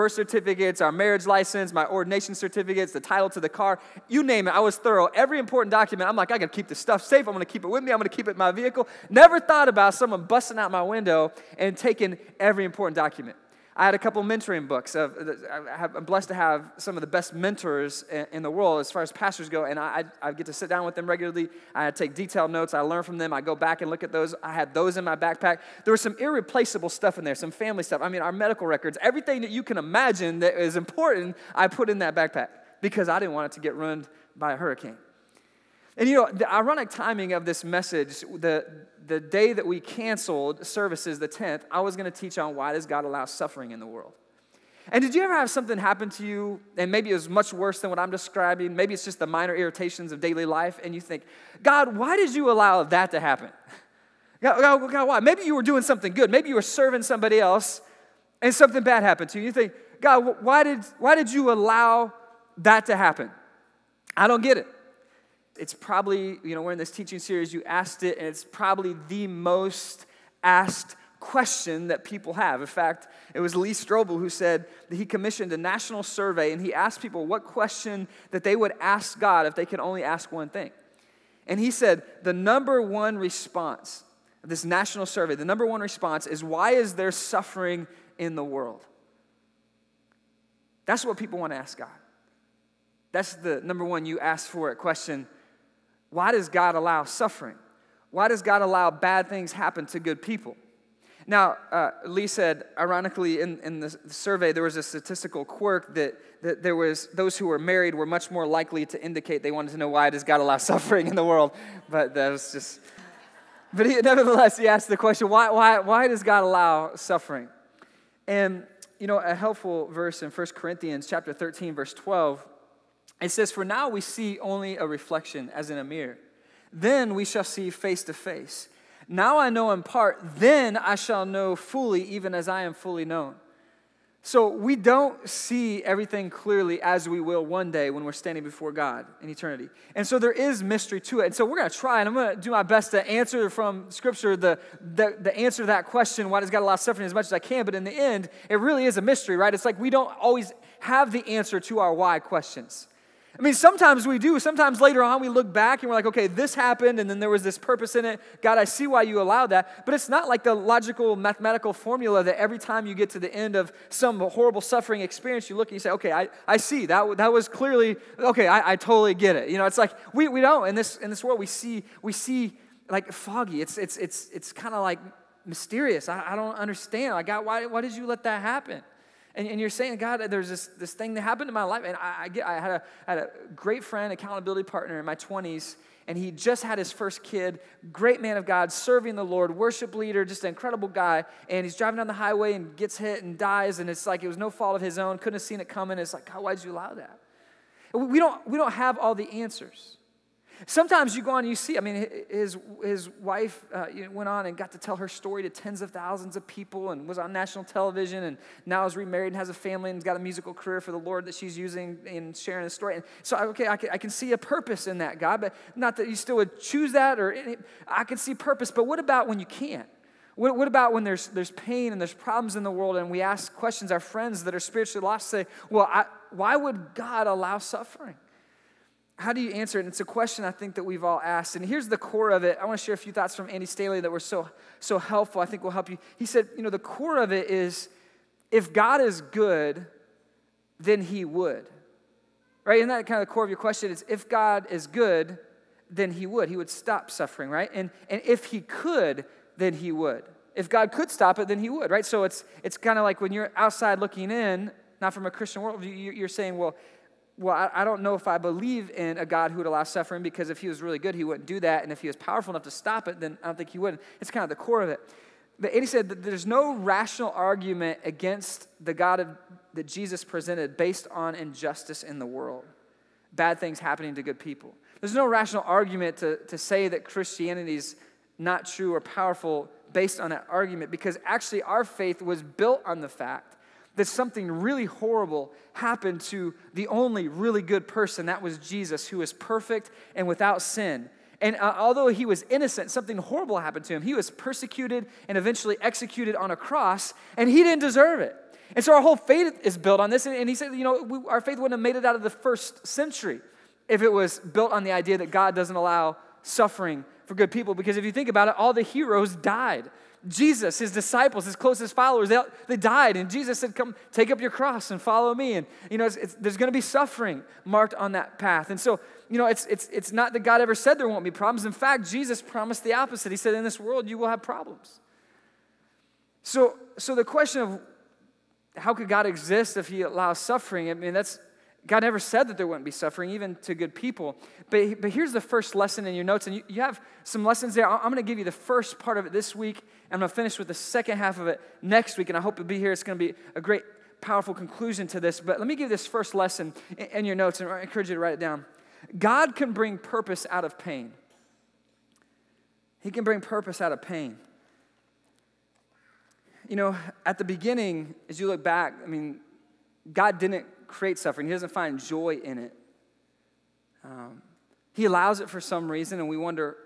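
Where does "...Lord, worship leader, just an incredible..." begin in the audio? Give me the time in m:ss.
3:09.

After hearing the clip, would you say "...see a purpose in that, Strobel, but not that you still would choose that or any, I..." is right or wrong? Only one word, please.
wrong.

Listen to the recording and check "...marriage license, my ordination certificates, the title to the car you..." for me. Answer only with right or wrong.
right.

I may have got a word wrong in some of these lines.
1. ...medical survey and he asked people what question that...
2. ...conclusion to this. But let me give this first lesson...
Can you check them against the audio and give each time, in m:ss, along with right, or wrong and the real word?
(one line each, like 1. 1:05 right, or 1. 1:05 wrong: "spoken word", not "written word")
1. 1:15 wrong: "national", not "medical"
2. 5:44 right.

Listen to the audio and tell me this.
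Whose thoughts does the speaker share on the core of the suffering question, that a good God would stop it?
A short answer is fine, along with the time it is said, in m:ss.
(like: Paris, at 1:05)
Andy Stanley, at 3:53.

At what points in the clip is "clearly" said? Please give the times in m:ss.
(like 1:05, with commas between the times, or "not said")
2:16, 2:47.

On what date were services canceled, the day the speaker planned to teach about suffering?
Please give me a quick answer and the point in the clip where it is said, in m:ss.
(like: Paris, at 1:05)
10th, at 0:41.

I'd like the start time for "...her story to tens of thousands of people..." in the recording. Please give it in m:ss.
3:24.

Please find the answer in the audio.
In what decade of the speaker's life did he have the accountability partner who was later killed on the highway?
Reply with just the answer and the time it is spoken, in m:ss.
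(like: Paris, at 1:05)
20s, at 3:05.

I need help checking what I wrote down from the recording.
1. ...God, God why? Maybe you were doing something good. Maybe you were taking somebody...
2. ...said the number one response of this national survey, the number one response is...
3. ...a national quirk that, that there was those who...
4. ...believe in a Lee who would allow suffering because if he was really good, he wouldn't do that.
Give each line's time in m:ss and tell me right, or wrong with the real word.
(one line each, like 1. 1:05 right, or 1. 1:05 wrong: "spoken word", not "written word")
1. 0:54 wrong: "serving", not "taking"
2. 1:21 right
3. 1:44 wrong: "statistical", not "national"
4. 4:18 wrong: "God", not "Lee".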